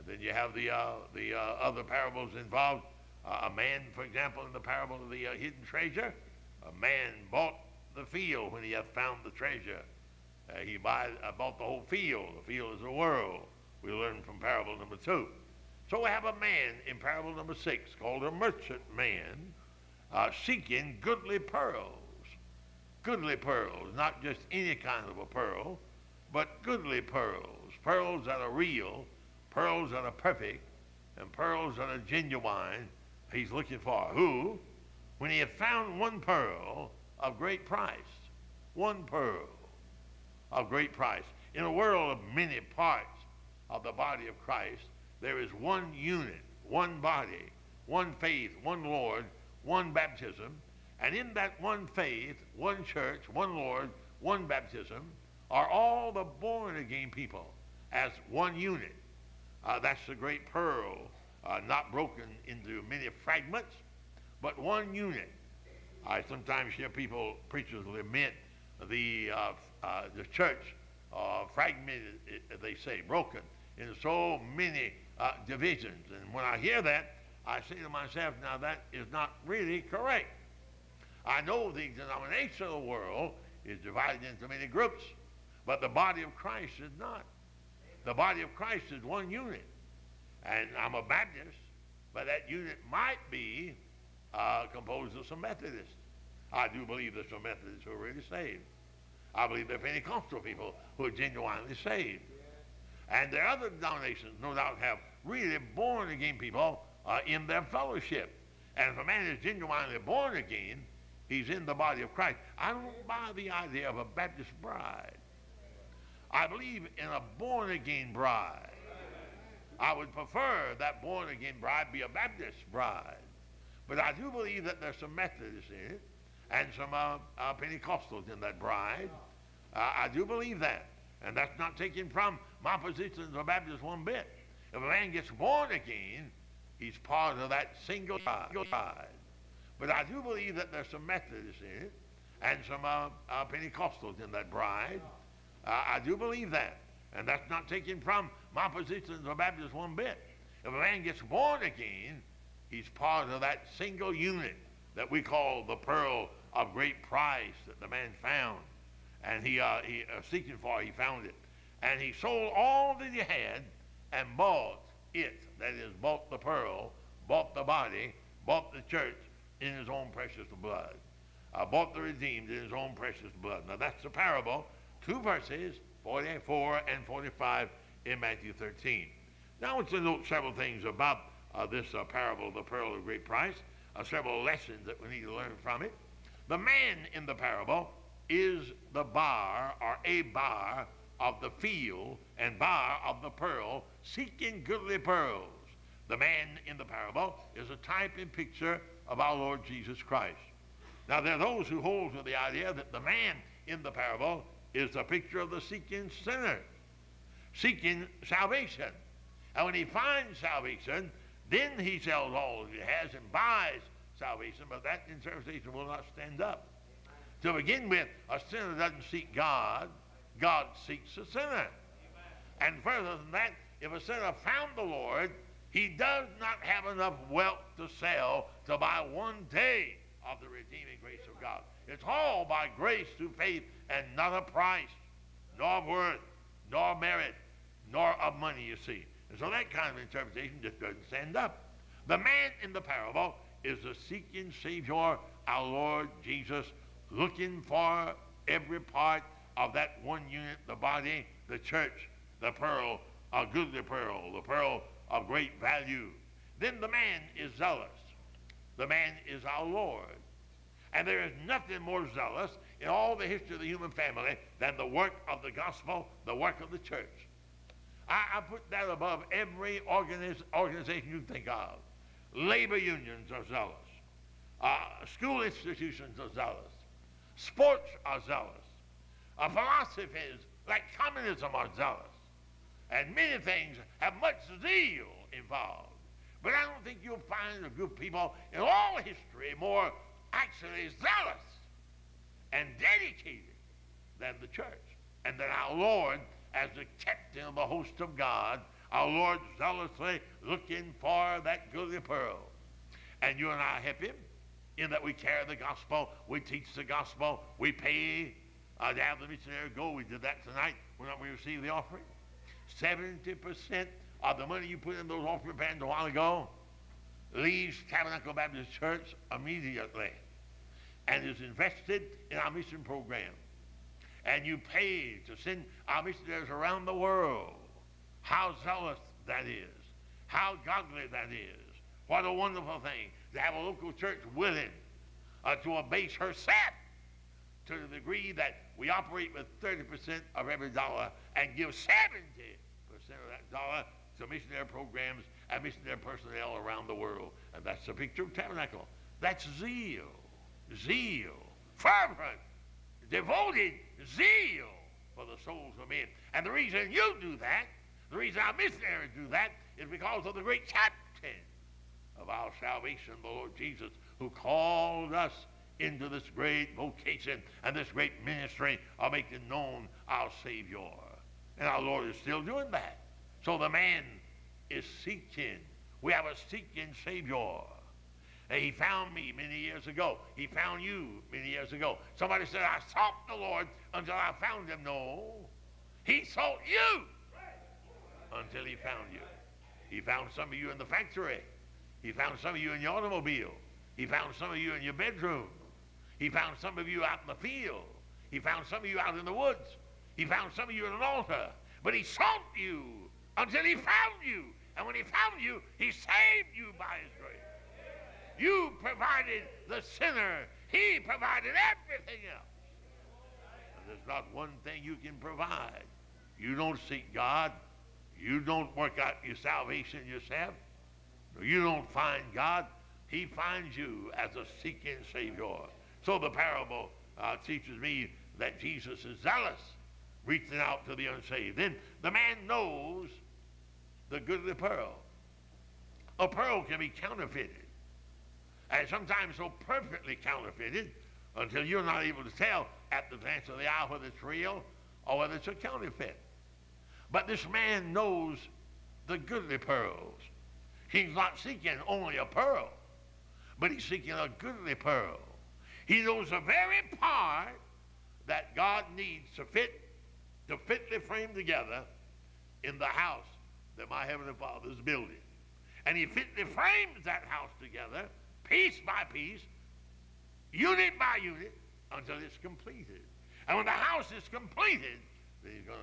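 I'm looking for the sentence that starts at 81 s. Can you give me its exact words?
I know the denominational world is divided into many groups, but the body of Christ is not.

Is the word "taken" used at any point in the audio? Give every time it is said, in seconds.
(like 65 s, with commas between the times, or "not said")
131 s, 147 s.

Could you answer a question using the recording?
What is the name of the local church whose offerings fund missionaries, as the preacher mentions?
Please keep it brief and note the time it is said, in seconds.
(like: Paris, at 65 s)
Tabernacle Baptist Church, at 317 s.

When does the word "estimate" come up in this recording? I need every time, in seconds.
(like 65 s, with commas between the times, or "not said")
not said.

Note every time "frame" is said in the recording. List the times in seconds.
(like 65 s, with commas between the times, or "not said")
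460 s, 466 s.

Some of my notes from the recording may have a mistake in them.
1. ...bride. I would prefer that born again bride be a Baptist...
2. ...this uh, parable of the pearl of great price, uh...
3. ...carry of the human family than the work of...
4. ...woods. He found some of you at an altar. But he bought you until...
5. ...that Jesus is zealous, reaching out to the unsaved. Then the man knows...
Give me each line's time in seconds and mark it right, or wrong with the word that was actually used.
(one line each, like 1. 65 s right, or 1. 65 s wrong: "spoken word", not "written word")
1. 118 s right
2. 181 s right
3. 263 s wrong: "history", not "carry"
4. 399 s wrong: "sought", not "bought"
5. 428 s right.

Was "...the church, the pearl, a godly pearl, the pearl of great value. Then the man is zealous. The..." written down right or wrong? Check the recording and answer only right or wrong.
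wrong.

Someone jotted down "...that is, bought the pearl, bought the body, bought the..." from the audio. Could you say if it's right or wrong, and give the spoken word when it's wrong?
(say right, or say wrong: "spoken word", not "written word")
right.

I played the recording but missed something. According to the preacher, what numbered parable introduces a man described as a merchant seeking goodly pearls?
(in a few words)
6.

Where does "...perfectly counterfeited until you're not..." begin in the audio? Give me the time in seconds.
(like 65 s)
439 s.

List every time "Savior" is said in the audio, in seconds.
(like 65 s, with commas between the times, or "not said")
244 s, 370 s, 377 s, 425 s.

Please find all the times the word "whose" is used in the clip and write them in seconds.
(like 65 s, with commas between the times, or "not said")
not said.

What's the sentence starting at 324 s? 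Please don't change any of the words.
And you pay to send our missionaries around the world.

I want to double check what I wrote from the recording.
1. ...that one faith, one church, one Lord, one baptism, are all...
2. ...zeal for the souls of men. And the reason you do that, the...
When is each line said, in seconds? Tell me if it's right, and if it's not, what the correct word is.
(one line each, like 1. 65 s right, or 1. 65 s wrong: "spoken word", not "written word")
1. 51 s right
2. 354 s right.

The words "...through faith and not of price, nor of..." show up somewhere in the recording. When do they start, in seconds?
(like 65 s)
233 s.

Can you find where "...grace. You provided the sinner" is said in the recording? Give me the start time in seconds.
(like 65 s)
407 s.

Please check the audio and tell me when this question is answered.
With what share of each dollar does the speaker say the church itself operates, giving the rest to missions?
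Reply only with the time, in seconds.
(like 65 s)
339 s.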